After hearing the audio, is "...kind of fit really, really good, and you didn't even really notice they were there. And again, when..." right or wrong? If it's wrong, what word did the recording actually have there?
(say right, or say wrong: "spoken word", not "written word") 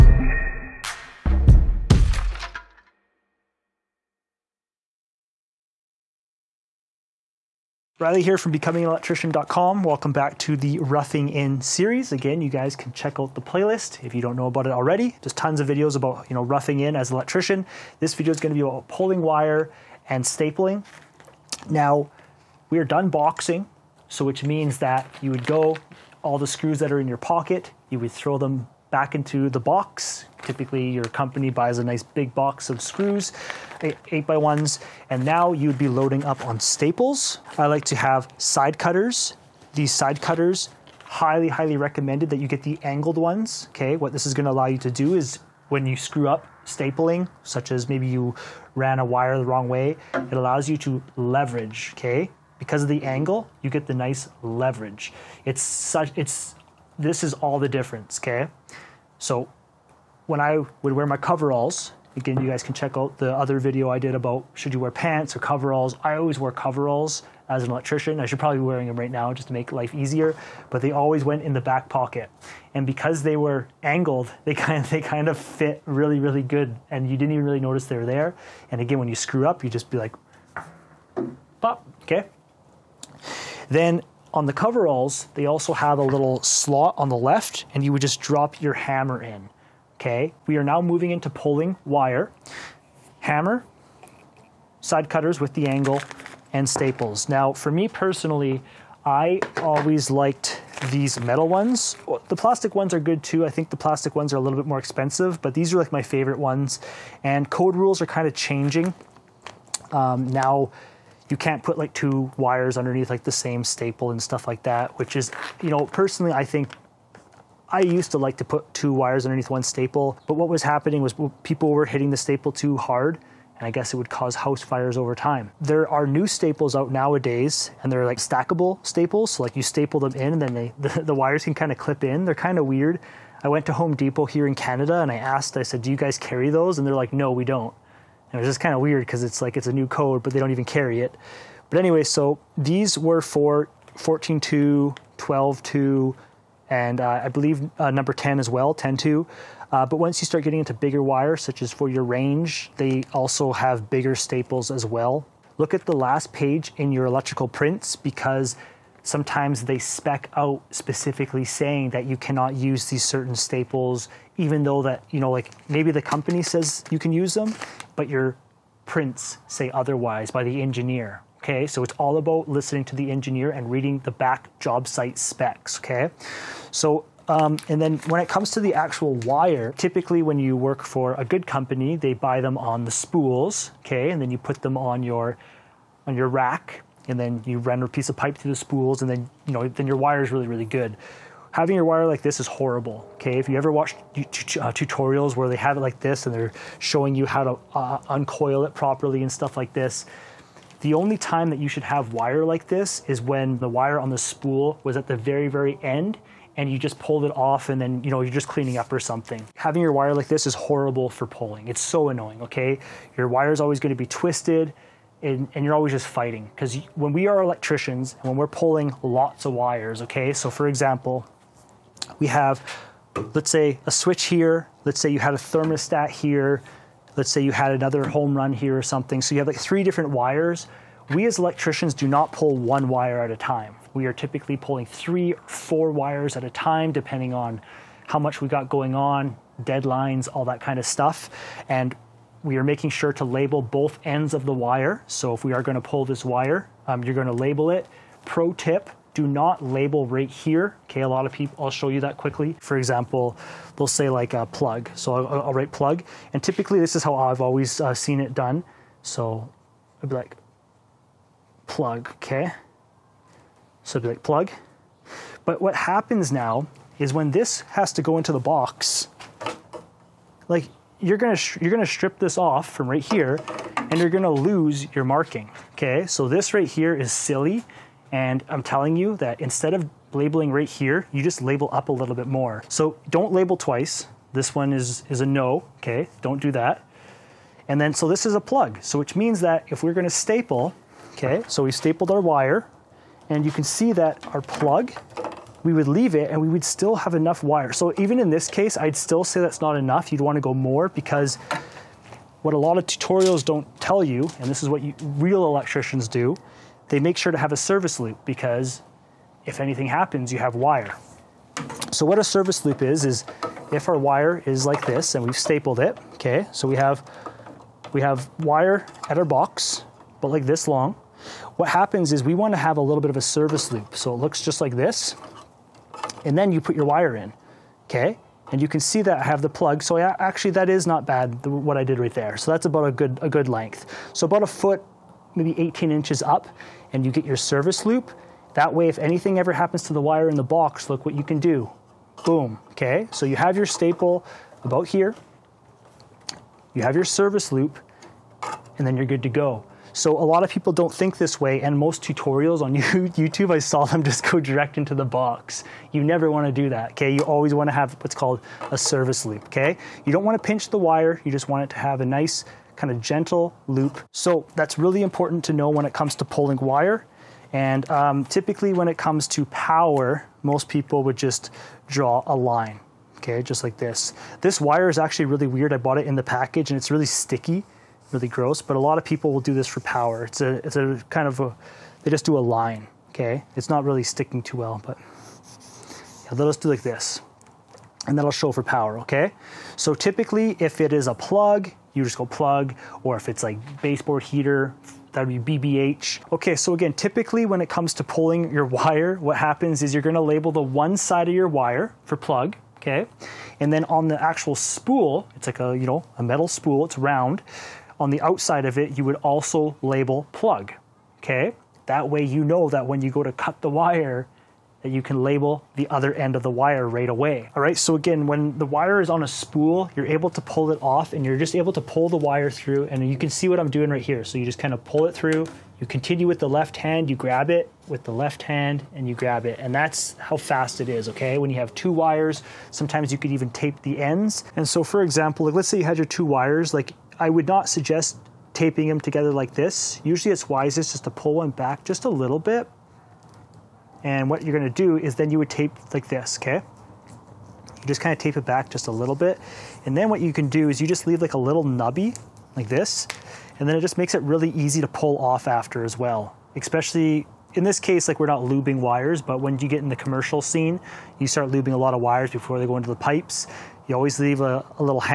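right.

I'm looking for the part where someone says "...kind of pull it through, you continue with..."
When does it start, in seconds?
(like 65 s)
424 s.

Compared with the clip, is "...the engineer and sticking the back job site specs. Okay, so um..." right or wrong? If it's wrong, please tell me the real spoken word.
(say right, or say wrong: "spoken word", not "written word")
wrong: "reading", not "sticking".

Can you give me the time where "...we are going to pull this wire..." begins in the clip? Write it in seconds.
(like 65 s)
245 s.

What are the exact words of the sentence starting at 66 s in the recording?
I always wear coveralls as an electrician.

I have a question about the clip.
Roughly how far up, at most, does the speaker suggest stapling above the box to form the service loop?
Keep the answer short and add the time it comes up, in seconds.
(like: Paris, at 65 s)
18 inches, at 335 s.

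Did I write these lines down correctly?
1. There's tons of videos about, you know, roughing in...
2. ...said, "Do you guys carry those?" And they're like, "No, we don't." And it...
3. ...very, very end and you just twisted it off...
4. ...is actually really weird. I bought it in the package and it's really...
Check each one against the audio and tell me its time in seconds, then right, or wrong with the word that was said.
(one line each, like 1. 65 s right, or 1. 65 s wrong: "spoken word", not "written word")
1. 15 s right
2. 135 s right
3. 205 s wrong: "pulled", not "twisted"
4. 374 s right.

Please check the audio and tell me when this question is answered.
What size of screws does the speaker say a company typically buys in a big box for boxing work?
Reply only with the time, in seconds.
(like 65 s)
34 s.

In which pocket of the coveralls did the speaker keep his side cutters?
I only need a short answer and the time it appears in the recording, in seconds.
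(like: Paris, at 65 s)
Back pocket, at 71 s.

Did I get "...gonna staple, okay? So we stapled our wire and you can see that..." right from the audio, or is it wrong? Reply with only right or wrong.
right.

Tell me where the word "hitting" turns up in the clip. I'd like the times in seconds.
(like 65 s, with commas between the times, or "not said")
121 s.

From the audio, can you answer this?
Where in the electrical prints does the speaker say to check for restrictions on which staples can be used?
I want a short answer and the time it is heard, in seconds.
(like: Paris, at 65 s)
The last page, at 155 s.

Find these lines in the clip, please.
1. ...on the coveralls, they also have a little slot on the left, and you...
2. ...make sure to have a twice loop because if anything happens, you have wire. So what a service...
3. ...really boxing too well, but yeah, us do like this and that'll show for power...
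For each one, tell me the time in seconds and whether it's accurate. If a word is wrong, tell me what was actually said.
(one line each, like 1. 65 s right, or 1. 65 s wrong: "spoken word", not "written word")
1. 84 s right
2. 306 s wrong: "service", not "twice"
3. 383 s wrong: "sticking", not "boxing".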